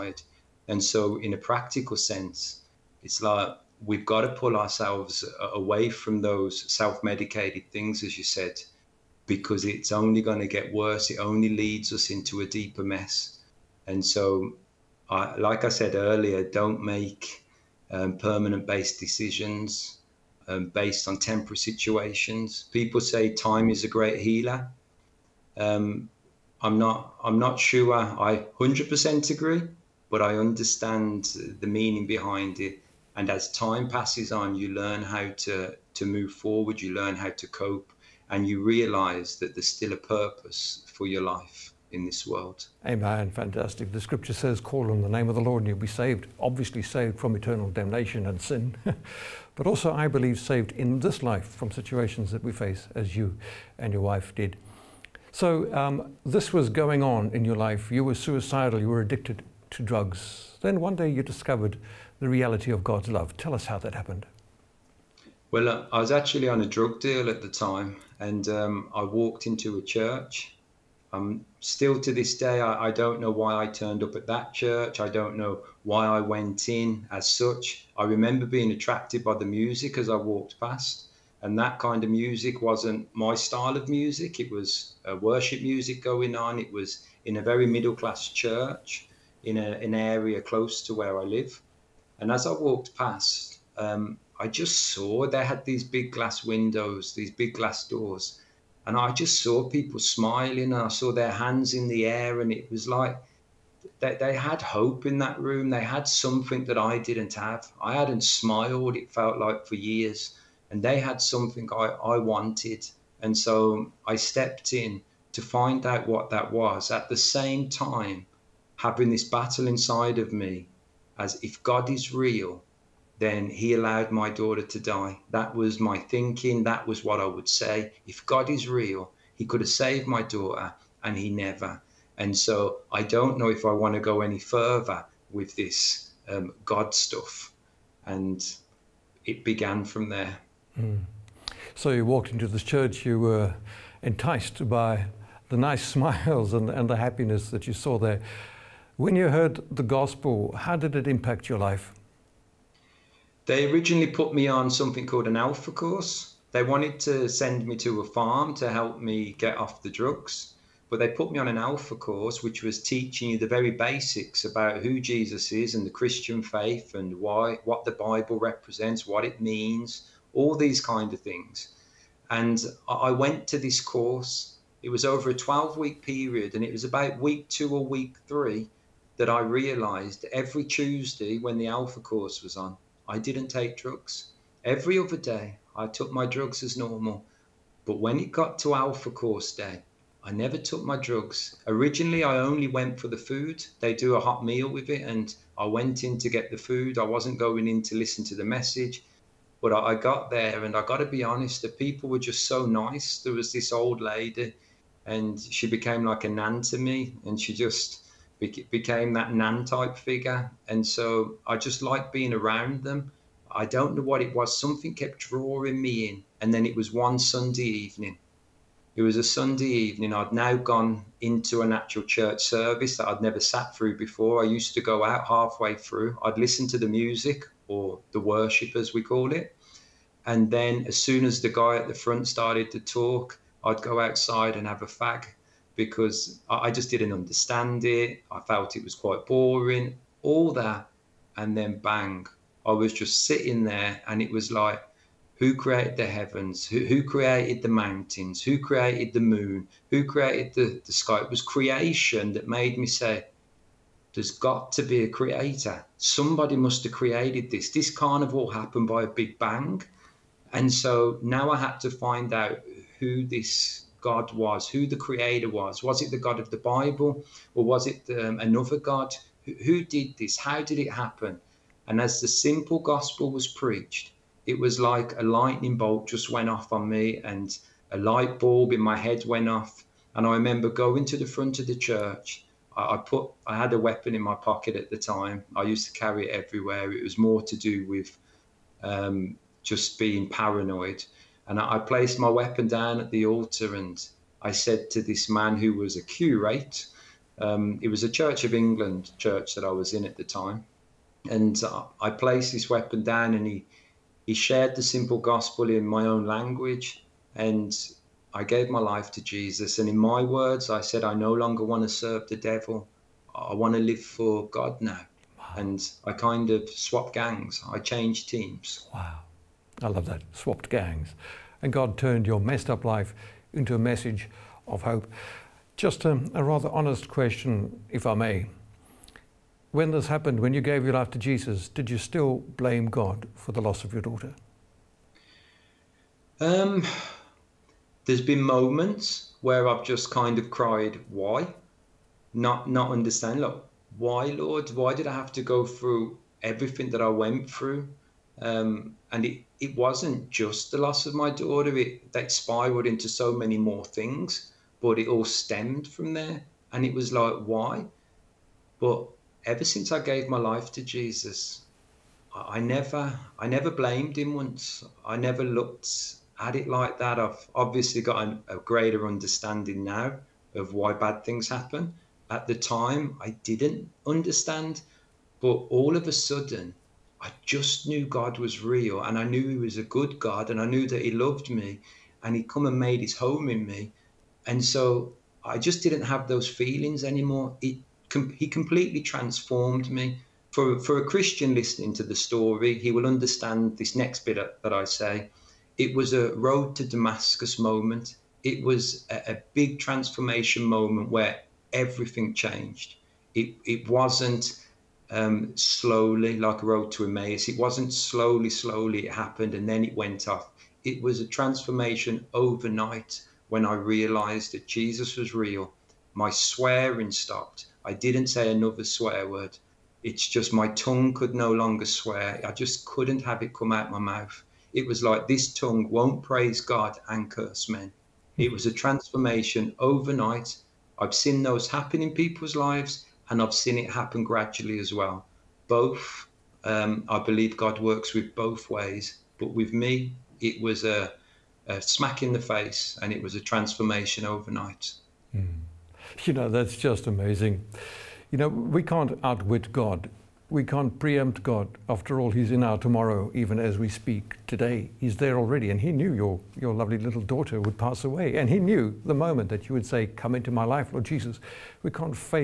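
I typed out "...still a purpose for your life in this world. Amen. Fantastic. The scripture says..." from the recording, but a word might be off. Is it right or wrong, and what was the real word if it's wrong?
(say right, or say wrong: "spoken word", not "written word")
right.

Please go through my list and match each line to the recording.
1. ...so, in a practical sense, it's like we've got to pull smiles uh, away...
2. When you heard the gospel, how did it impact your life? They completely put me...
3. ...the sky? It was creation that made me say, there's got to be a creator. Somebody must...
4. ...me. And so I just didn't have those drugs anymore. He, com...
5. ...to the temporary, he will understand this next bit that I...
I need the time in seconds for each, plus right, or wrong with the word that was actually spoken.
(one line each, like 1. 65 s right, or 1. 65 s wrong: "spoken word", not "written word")
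1. 0 s wrong: "ourselves", not "smiles"
2. 148 s wrong: "originally", not "completely"
3. 250 s right
4. 383 s wrong: "feelings", not "drugs"
5. 391 s wrong: "story", not "temporary".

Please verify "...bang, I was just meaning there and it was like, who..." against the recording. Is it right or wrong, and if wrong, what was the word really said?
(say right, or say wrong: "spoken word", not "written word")
wrong: "sitting", not "meaning".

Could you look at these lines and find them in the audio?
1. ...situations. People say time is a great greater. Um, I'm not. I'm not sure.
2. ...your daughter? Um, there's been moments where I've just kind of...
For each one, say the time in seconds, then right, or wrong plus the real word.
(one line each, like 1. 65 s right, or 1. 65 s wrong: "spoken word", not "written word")
1. 21 s wrong: "healer", not "greater"
2. 333 s right.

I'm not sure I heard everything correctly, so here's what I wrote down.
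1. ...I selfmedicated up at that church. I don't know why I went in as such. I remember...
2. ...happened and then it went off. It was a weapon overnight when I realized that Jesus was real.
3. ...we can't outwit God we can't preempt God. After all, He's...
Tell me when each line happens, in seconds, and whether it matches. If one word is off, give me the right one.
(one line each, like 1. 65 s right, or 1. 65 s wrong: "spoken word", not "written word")
1. 73 s wrong: "turned", not "selfmedicated"
2. 409 s wrong: "transformation", not "weapon"
3. 448 s right.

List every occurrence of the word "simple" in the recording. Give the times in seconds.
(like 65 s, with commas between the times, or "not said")
272 s, 304 s.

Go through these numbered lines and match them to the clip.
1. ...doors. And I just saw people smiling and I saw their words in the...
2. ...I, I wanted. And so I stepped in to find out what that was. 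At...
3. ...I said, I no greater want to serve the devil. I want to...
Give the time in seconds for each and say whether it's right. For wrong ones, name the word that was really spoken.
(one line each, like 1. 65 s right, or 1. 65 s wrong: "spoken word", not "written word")
1. 97 s wrong: "hands", not "words"
2. 111 s right
3. 310 s wrong: "longer", not "greater".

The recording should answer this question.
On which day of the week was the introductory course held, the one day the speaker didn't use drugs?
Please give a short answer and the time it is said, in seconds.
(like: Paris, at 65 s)
Tuesday, at 180 s.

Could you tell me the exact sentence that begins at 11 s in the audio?
It only leads us into a deeper mess.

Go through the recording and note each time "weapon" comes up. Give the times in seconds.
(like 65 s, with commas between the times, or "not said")
283 s, 292 s, 302 s.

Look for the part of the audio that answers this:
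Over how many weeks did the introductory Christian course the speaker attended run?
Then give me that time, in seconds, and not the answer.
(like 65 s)
175 s.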